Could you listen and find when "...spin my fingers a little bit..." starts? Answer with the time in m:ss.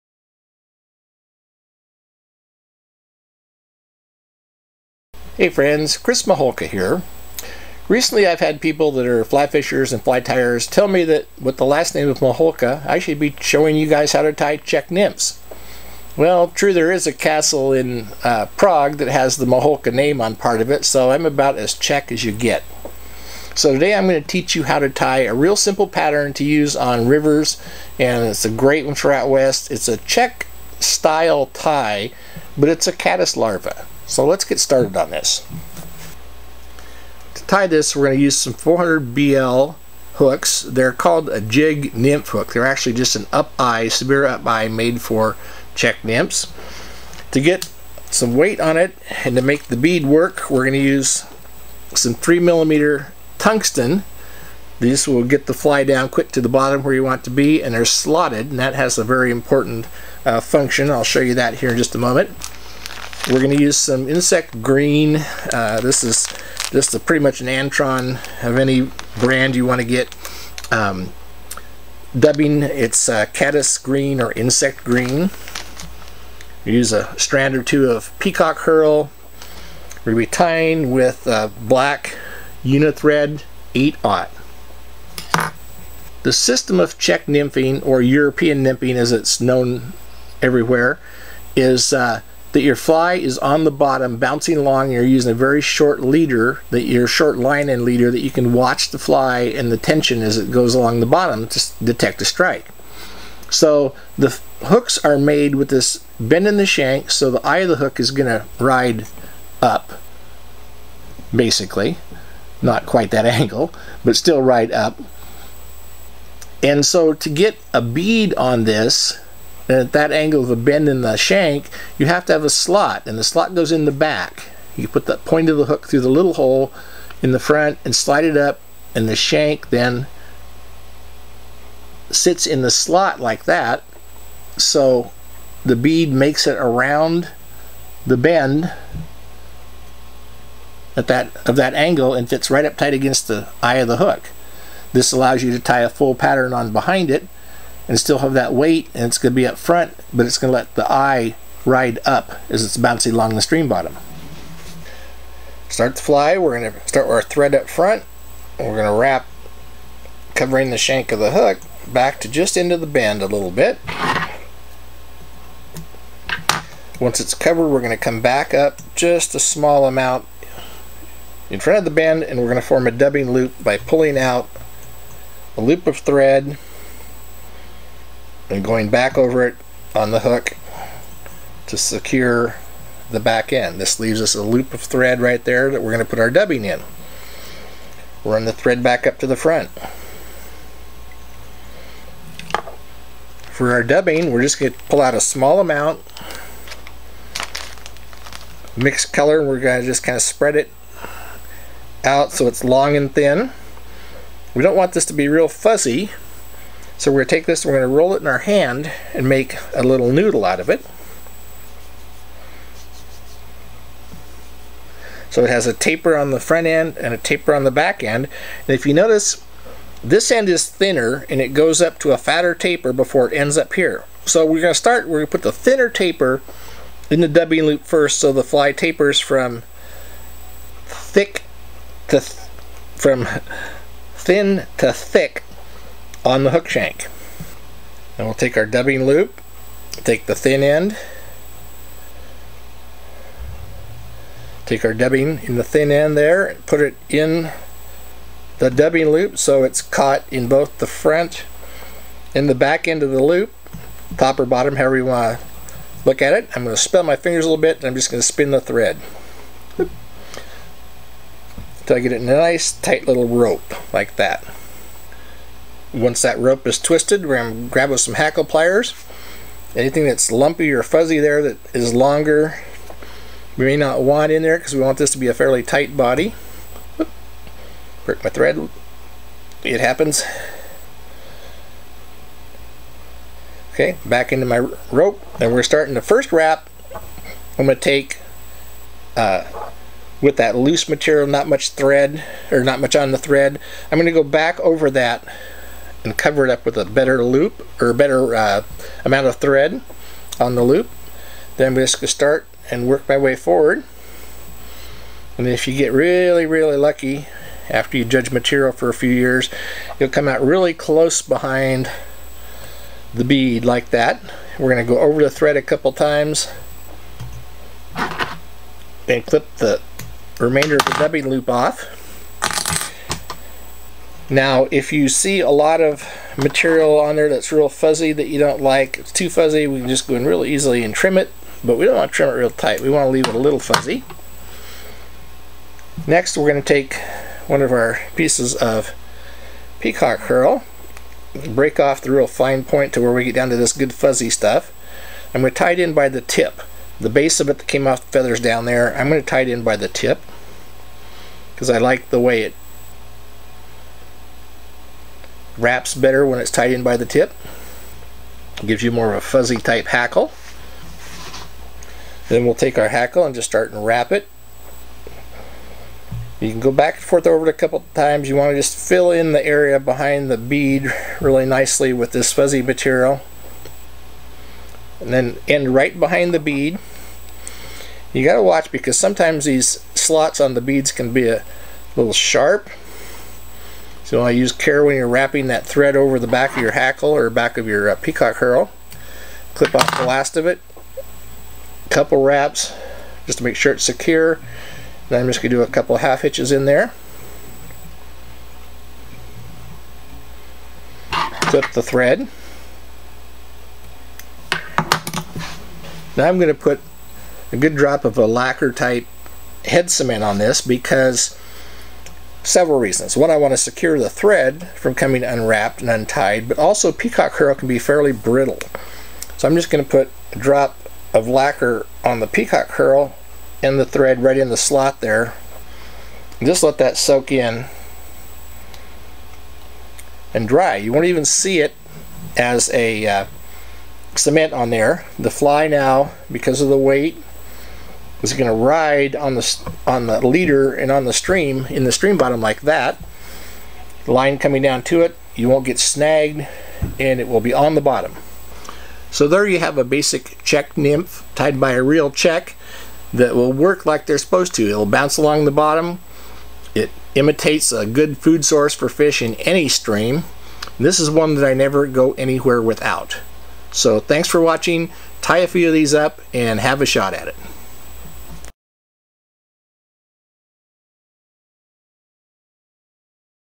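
4:16.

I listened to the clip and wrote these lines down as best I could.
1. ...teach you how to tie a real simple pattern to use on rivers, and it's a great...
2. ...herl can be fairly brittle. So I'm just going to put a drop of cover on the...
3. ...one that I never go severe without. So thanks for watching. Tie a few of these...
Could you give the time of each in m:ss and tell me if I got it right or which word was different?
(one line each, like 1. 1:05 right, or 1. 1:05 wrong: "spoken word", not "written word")
1. 0:24 right
2. 6:57 wrong: "lacquer", not "cover"
3. 7:41 wrong: "anywhere", not "severe".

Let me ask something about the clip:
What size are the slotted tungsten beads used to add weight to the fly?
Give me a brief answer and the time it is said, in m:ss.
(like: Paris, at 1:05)
3 millimeter, at 0:52.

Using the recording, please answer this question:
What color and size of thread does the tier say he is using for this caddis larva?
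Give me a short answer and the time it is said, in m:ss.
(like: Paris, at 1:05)
Black 8/0 Unithread, at 1:21.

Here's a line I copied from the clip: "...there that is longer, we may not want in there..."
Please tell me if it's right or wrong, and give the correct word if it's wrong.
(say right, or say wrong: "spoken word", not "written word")
right.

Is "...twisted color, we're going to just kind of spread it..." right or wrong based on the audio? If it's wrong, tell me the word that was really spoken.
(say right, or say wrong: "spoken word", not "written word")
wrong: "mixed", not "twisted".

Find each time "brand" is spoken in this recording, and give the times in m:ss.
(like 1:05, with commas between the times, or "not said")
1:09.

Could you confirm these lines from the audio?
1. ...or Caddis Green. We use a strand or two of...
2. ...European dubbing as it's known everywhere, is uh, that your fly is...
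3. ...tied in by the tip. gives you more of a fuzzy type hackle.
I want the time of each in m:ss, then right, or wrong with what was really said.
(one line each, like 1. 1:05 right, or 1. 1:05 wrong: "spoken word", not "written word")
1. 1:14 wrong: "Insect", not "Caddis"
2. 1:28 wrong: "nymphing", not "dubbing"
3. 5:56 right.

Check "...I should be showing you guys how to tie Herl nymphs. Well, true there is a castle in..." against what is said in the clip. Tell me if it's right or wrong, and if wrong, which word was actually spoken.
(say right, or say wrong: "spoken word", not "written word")
wrong: "Czech", not "Herl".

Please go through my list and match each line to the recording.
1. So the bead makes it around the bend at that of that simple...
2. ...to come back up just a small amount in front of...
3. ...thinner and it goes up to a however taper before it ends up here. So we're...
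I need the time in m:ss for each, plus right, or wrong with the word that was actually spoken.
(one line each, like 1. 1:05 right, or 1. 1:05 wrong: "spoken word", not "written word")
1. 2:14 wrong: "angle", not "simple"
2. 2:47 right
3. 3:40 wrong: "fatter", not "however".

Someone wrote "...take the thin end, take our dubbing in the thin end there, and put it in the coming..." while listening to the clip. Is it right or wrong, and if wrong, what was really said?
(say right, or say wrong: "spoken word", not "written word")
wrong: "dubbing", not "coming".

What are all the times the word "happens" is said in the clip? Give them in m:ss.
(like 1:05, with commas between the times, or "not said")
4:39.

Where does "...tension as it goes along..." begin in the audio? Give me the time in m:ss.
1:39.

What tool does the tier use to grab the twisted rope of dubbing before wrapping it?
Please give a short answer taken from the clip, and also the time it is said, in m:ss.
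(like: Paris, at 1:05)
Hackle pliers, at 4:28.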